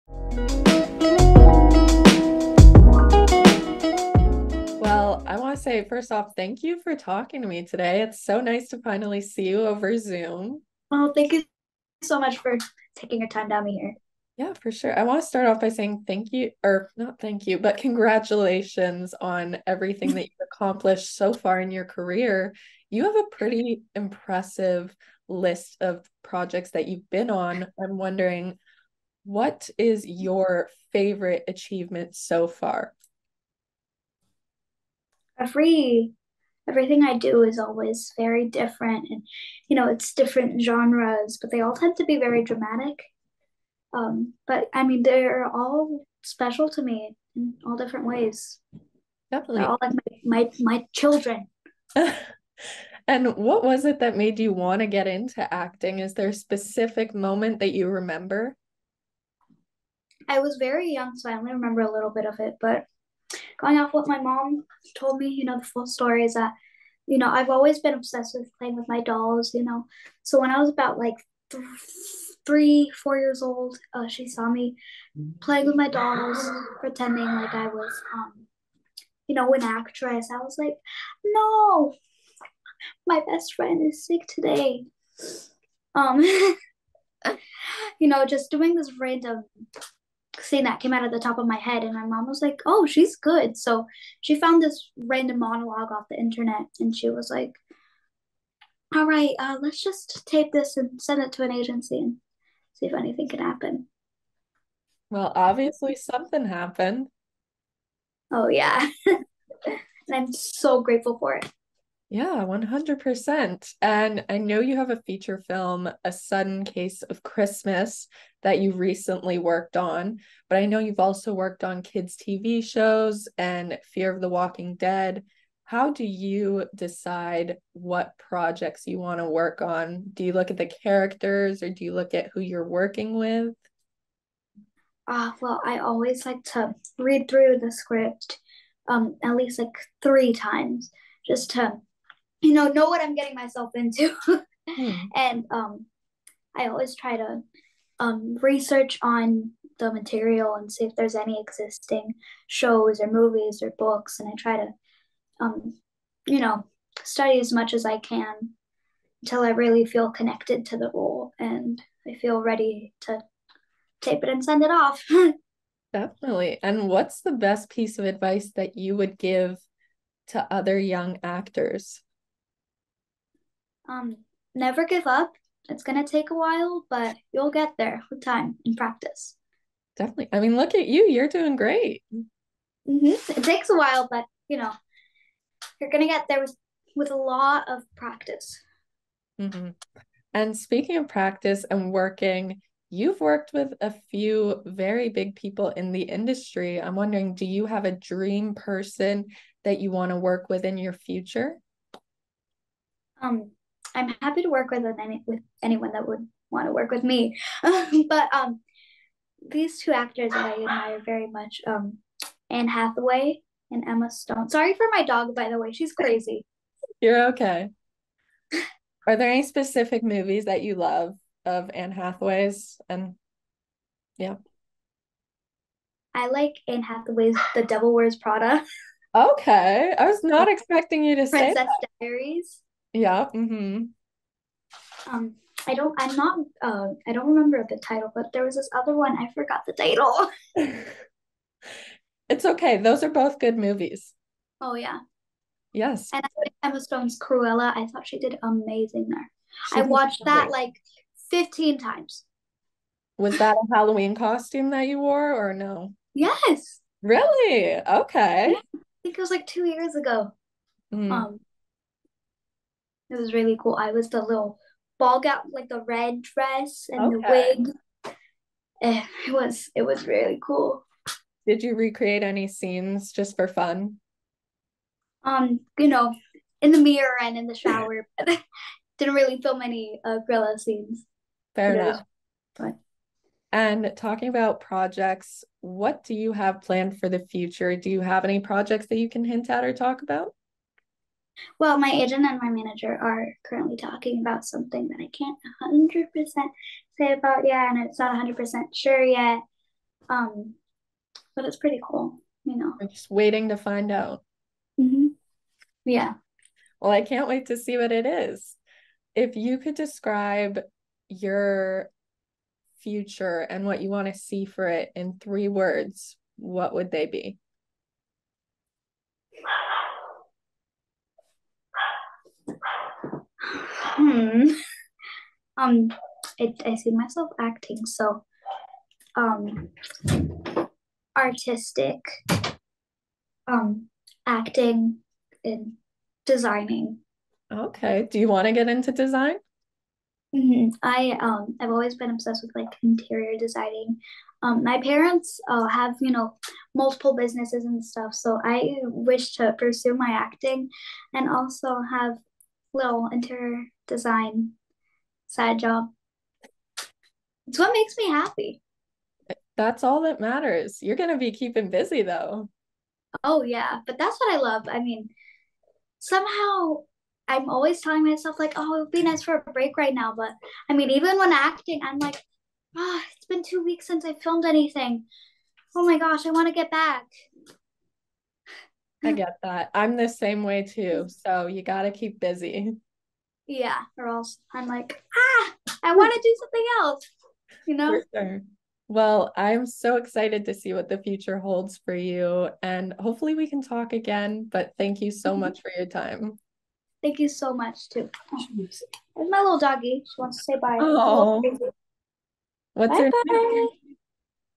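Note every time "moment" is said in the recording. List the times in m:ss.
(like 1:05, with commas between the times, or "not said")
0:57.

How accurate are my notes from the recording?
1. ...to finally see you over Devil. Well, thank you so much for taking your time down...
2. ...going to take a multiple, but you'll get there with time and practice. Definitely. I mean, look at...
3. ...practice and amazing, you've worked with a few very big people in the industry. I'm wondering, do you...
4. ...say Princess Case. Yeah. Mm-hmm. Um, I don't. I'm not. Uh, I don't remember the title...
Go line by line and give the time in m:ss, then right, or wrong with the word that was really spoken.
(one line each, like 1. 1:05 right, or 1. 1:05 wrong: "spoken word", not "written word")
1. 0:08 wrong: "Zoom", not "Devil"
2. 2:55 wrong: "while", not "multiple"
3. 3:11 wrong: "working", not "amazing"
4. 3:51 wrong: "Diaries", not "Case".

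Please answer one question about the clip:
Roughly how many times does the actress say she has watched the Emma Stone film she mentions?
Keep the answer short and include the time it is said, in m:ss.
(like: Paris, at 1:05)
15, at 4:11.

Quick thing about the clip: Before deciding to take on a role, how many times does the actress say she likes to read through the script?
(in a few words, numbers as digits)
3.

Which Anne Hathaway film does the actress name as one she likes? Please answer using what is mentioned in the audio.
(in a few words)
The Devil Wears Prada.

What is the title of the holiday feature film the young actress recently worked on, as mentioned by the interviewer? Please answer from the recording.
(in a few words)
A Sudden Case of Christmas.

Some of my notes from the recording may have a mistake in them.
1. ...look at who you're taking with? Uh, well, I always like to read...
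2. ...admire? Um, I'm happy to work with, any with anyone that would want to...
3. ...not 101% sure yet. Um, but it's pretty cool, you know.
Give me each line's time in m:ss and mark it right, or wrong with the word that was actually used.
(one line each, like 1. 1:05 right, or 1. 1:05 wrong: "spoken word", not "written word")
1. 2:11 wrong: "working", not "taking"
2. 3:20 wrong: "future", not "admire"
3. 4:57 wrong: "100", not "101".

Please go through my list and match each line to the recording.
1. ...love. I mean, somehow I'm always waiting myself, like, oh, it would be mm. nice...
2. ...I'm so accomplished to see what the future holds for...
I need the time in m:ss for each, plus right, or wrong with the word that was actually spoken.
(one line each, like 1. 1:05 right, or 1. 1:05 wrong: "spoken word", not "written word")
1. 6:04 wrong: "telling", not "waiting"
2. 6:29 wrong: "excited", not "accomplished".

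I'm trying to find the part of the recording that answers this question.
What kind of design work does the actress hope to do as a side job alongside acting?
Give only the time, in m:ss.
5:42.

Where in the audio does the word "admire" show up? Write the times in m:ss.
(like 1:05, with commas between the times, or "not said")
3:30.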